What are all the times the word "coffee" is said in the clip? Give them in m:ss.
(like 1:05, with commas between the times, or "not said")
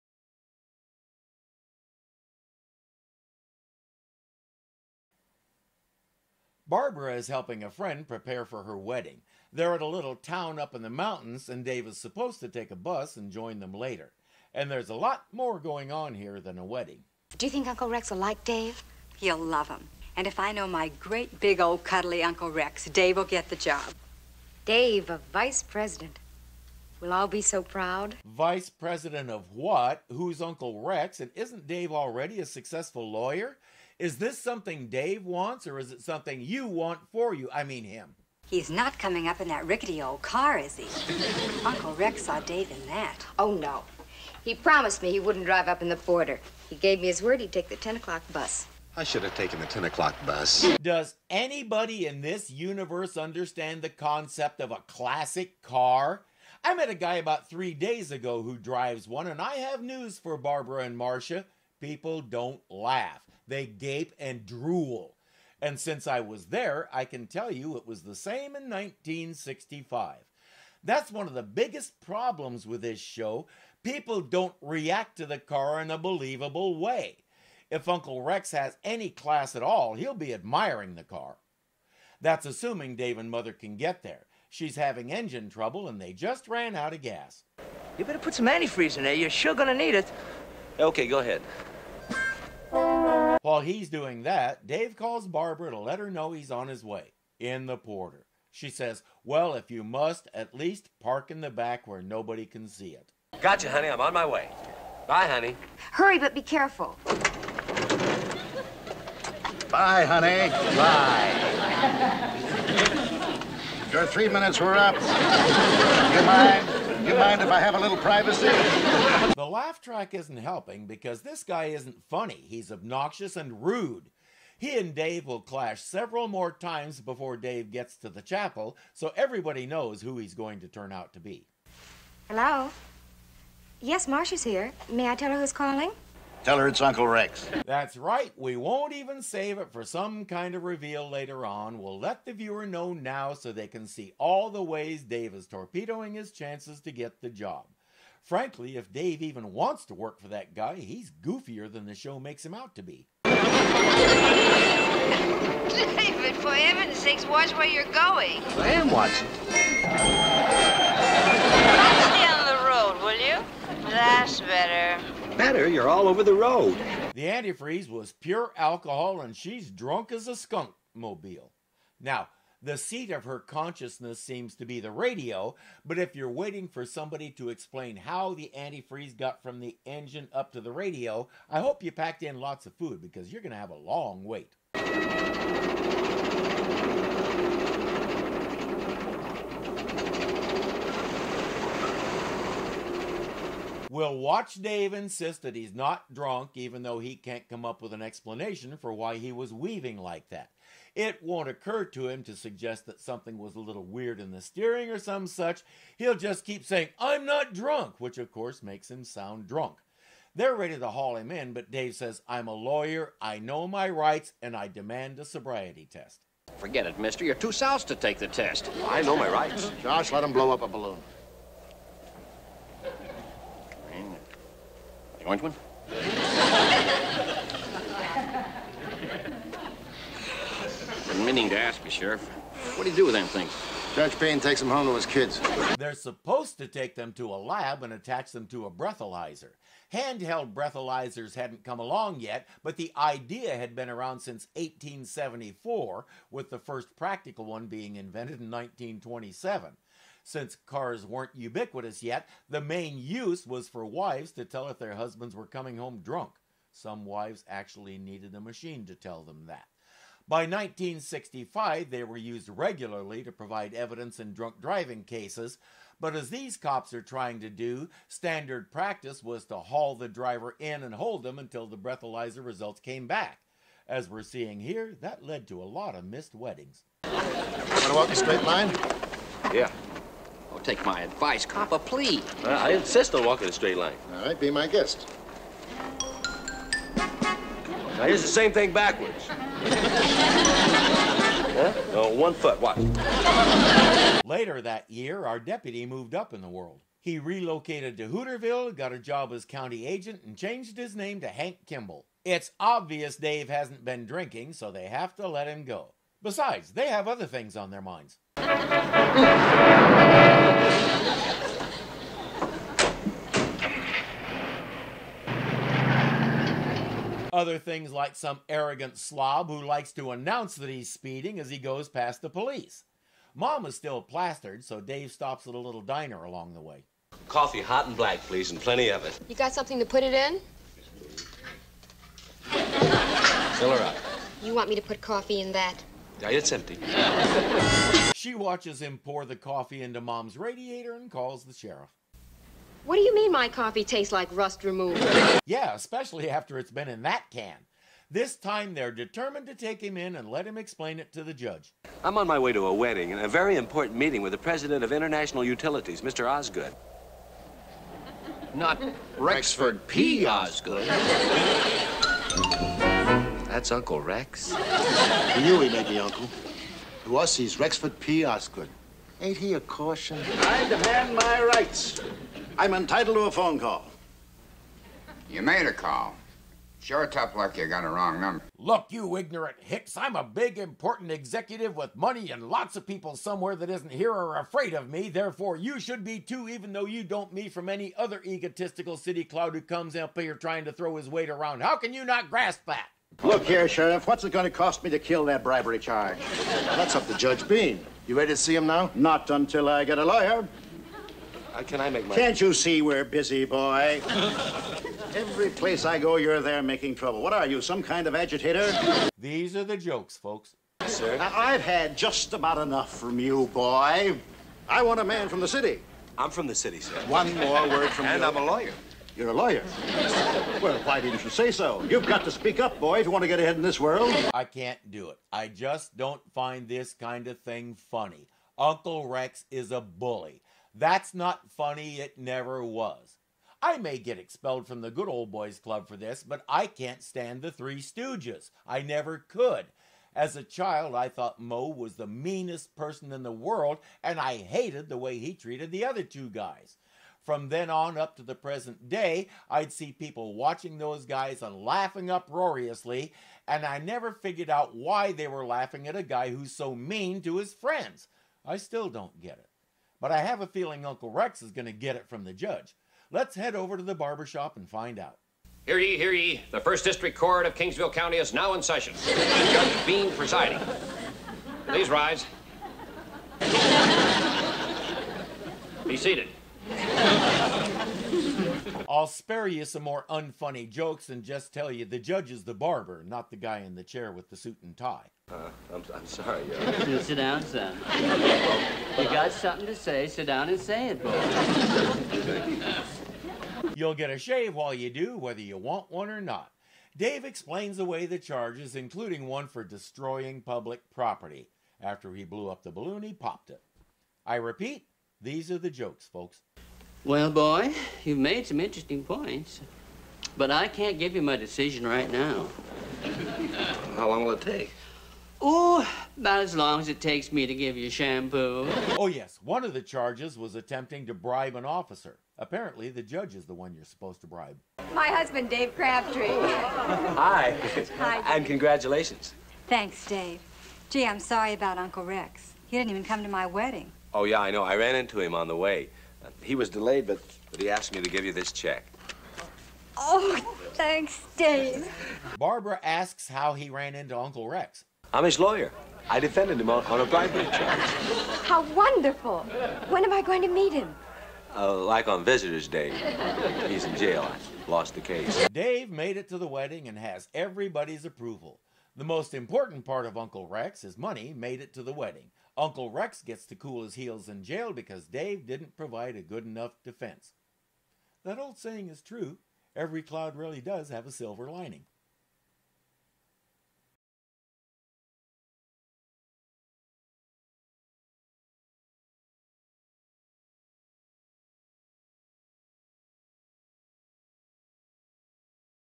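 5:27, 5:35, 5:39, 5:43.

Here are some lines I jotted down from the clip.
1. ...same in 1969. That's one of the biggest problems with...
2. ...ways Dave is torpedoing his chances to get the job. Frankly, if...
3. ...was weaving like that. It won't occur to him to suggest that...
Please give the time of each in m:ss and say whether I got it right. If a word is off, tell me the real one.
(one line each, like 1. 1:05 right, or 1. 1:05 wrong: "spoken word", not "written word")
1. 1:08 wrong: "1965", not "1969"
2. 2:24 right
3. 3:19 right.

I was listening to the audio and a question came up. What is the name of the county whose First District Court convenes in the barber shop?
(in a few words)
Kingsville County.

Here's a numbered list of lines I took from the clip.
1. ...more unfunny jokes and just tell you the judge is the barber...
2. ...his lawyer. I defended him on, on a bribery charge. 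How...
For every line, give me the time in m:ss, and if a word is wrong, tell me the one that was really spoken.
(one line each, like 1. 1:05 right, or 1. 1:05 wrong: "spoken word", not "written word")
1. 7:59 right
2. 9:05 right.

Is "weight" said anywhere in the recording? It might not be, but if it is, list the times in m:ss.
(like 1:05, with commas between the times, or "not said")
6:31.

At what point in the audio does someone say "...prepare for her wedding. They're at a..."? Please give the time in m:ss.
0:08.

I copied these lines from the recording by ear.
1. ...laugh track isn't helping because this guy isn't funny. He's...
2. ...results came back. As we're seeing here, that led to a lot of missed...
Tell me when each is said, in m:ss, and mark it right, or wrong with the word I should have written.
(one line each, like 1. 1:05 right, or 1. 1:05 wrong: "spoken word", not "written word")
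1. 1:59 right
2. 4:32 right.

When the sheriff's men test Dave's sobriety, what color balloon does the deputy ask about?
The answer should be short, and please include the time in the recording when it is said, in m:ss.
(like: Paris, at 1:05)
Orange, at 3:45.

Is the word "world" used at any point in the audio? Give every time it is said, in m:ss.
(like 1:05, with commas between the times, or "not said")
4:56, 7:03, 7:23.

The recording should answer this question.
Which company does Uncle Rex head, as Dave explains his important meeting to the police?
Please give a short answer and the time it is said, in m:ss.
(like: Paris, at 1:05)
International Utilities, at 5:54.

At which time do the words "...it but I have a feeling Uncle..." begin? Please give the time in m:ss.
7:39.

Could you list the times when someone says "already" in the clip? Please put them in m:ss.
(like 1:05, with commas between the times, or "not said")
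0:31.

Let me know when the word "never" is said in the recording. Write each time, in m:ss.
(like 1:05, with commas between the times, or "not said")
7:12, 7:18, 7:33.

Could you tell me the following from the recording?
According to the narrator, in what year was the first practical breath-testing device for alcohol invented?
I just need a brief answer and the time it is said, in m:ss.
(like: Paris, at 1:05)
1927, at 4:08.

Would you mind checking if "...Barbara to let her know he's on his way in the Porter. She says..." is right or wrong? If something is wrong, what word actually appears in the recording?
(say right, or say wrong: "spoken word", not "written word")
right.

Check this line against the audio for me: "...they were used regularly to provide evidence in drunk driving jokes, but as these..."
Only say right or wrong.
wrong.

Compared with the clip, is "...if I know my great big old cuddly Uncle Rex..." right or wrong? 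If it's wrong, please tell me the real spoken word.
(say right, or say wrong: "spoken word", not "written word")
right.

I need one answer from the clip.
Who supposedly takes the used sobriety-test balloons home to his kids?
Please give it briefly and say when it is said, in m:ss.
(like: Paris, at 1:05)
Judge Payne, at 3:53.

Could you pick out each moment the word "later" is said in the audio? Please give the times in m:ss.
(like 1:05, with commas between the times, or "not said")
0:13, 2:21, 4:54.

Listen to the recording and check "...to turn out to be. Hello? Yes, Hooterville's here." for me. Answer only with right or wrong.
wrong.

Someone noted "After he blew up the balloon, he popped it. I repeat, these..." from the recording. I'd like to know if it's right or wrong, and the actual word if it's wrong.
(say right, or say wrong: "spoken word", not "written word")
right.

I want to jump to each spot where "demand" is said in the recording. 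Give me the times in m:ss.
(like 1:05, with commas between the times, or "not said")
3:34, 6:10.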